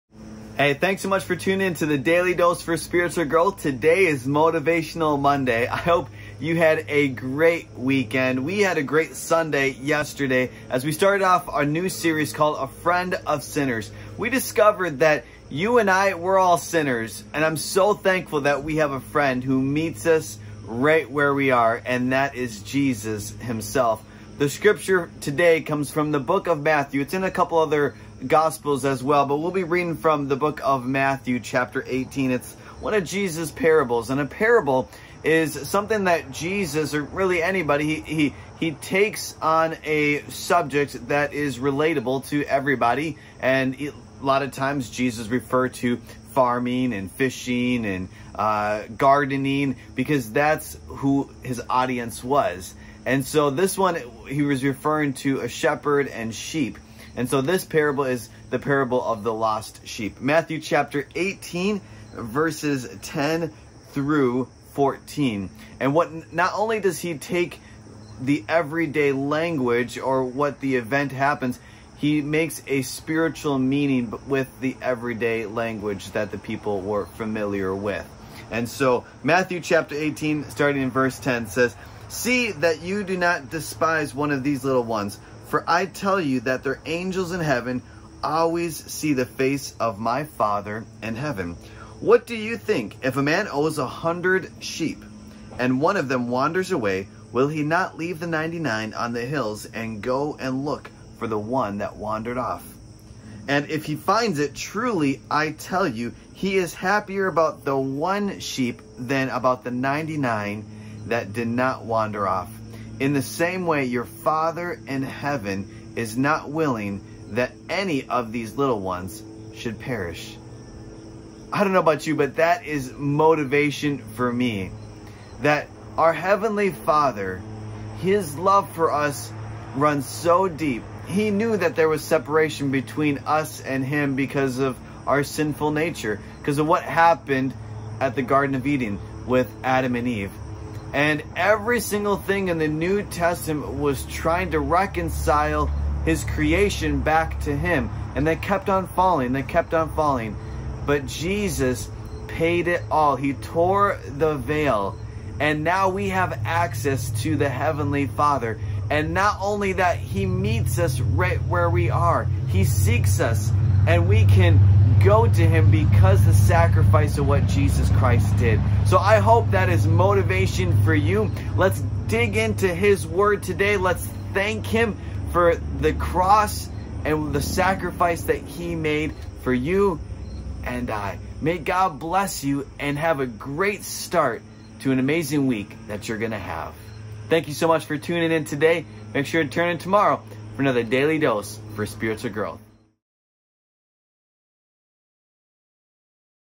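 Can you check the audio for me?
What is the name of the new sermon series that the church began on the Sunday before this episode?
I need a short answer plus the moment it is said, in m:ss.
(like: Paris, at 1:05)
A Friend of Sinners, at 0:12.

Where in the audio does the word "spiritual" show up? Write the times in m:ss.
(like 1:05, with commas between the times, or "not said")
0:02, 1:12, 3:11.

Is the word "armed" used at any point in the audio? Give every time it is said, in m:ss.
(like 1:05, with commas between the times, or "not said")
not said.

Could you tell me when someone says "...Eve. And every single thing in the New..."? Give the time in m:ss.
2:20.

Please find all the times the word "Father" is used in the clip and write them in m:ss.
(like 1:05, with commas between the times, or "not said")
1:30, 1:54, 2:06, 2:38.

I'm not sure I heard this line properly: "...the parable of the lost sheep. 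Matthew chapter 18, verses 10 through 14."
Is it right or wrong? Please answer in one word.
right.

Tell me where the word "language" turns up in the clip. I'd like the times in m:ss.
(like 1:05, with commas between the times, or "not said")
1:09, 1:15.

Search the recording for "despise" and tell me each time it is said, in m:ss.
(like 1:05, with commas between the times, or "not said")
1:23.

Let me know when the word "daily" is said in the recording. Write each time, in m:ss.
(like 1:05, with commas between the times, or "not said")
0:01, 3:10.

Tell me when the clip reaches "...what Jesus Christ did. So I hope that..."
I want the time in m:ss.
2:47.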